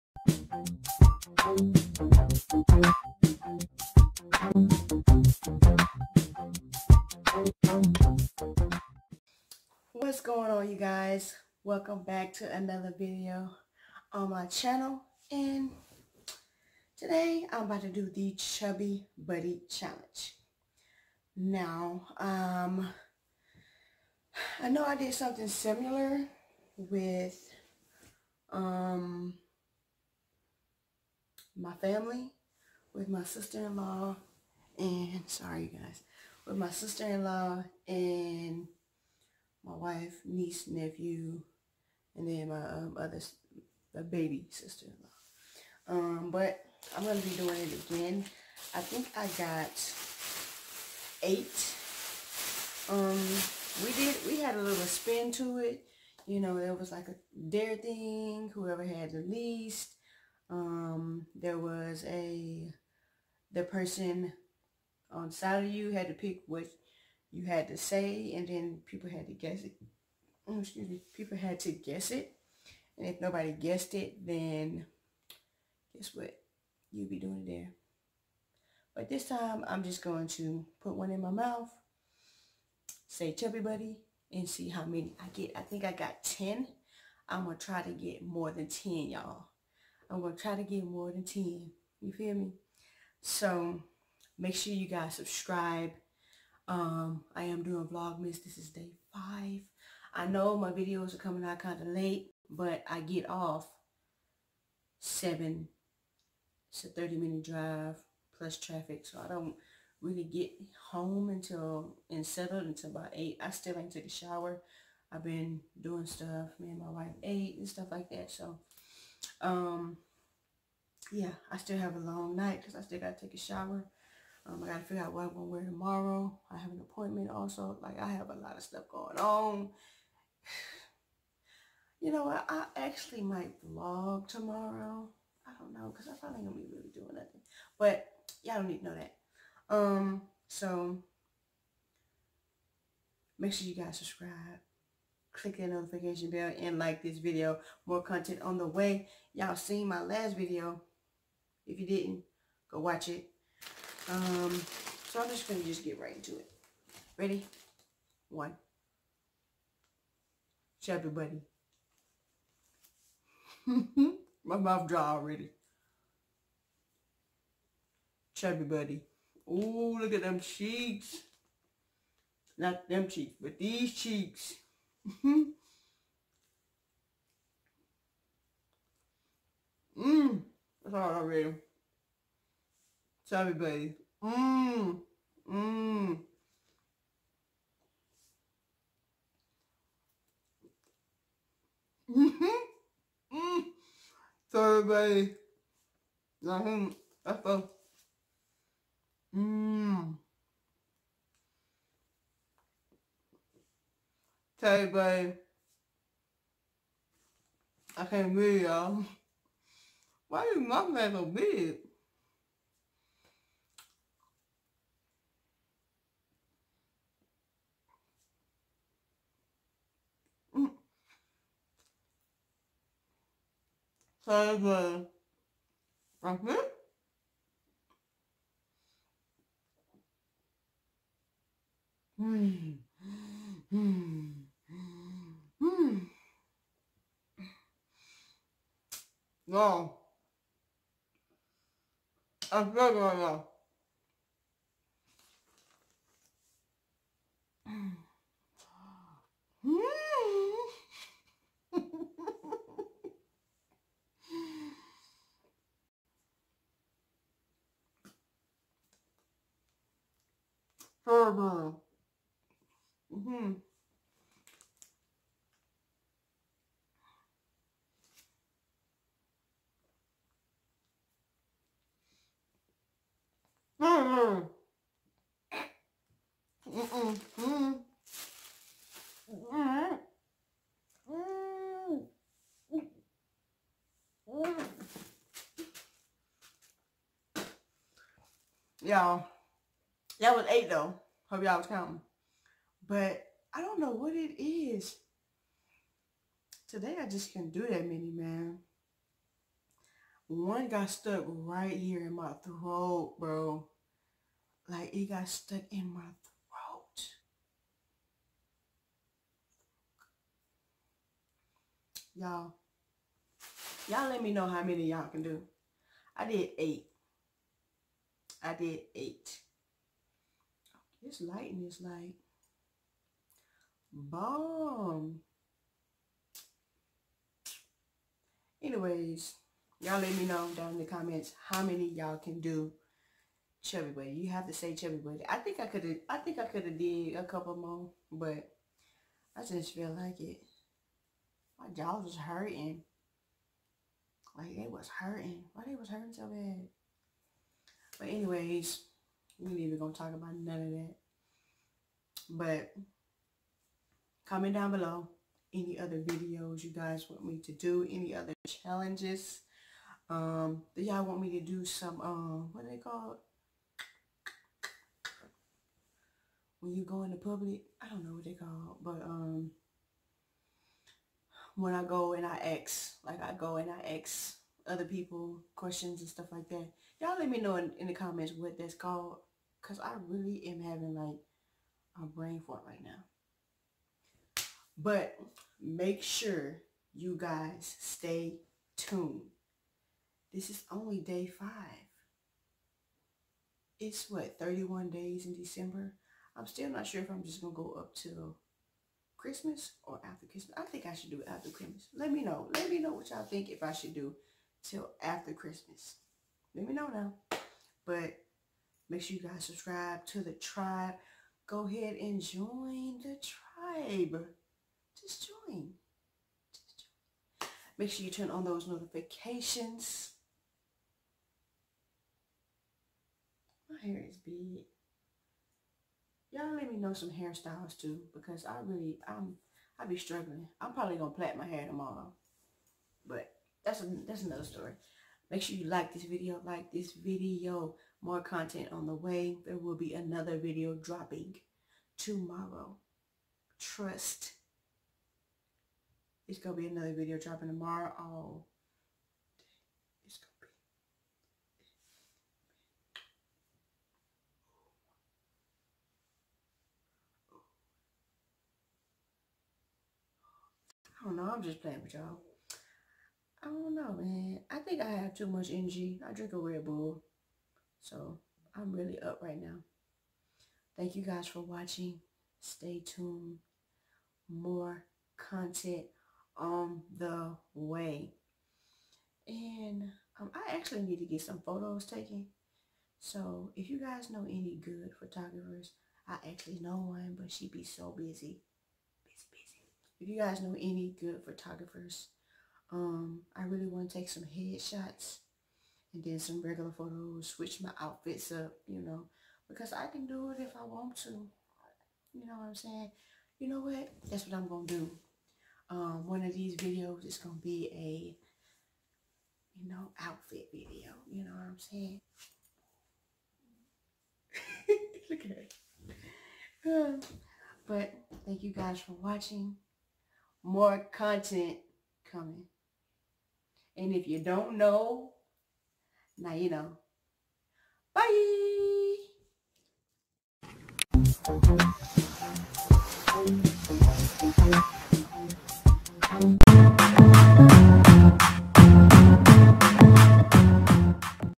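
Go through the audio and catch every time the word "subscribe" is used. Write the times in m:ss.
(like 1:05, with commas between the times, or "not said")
1:35, 2:23, 6:49.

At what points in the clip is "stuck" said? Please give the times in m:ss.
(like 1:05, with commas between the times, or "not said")
5:00, 5:05.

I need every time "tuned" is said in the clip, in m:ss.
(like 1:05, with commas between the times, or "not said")
6:28, 7:52.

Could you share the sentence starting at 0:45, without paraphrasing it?
Um, but I'm gonna be doing it again.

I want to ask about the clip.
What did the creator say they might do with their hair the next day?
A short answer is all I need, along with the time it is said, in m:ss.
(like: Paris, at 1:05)
plait, at 7:11.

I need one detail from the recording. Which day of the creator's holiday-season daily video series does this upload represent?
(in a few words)
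5.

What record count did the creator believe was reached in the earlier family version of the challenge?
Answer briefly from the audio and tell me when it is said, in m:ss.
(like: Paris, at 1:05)
10, at 1:25.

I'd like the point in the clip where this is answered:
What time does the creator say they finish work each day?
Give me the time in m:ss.
1:42.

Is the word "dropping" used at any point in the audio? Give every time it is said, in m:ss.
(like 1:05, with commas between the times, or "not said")
7:20, 7:27.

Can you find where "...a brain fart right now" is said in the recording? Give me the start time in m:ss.
6:22.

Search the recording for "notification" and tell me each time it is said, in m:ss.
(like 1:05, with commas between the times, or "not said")
2:25, 6:58.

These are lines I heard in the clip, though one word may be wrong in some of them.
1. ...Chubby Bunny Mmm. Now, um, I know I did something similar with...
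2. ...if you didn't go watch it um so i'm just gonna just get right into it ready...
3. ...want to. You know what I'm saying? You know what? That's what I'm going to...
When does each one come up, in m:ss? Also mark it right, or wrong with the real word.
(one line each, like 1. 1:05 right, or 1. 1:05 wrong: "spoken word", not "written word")
1. 0:18 wrong: "Challenge", not "Mmm"
2. 2:31 right
3. 8:20 right.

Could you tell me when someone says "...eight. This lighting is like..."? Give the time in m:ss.
5:18.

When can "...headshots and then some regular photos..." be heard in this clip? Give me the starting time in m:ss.
8:14.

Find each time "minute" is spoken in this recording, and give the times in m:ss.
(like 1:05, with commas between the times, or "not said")
1:47.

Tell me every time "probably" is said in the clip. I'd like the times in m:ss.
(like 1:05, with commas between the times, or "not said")
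2:16, 7:10.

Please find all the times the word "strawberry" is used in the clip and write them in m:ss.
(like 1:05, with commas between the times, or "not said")
not said.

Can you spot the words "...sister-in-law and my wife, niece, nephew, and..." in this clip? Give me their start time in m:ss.
0:36.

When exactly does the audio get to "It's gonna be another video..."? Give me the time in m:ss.
7:26.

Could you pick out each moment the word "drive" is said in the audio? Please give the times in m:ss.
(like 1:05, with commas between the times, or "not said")
1:47.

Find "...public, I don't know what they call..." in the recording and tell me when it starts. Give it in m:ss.
6:07.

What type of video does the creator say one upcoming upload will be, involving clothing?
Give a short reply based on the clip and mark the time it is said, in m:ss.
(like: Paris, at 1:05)
outfit video, at 8:29.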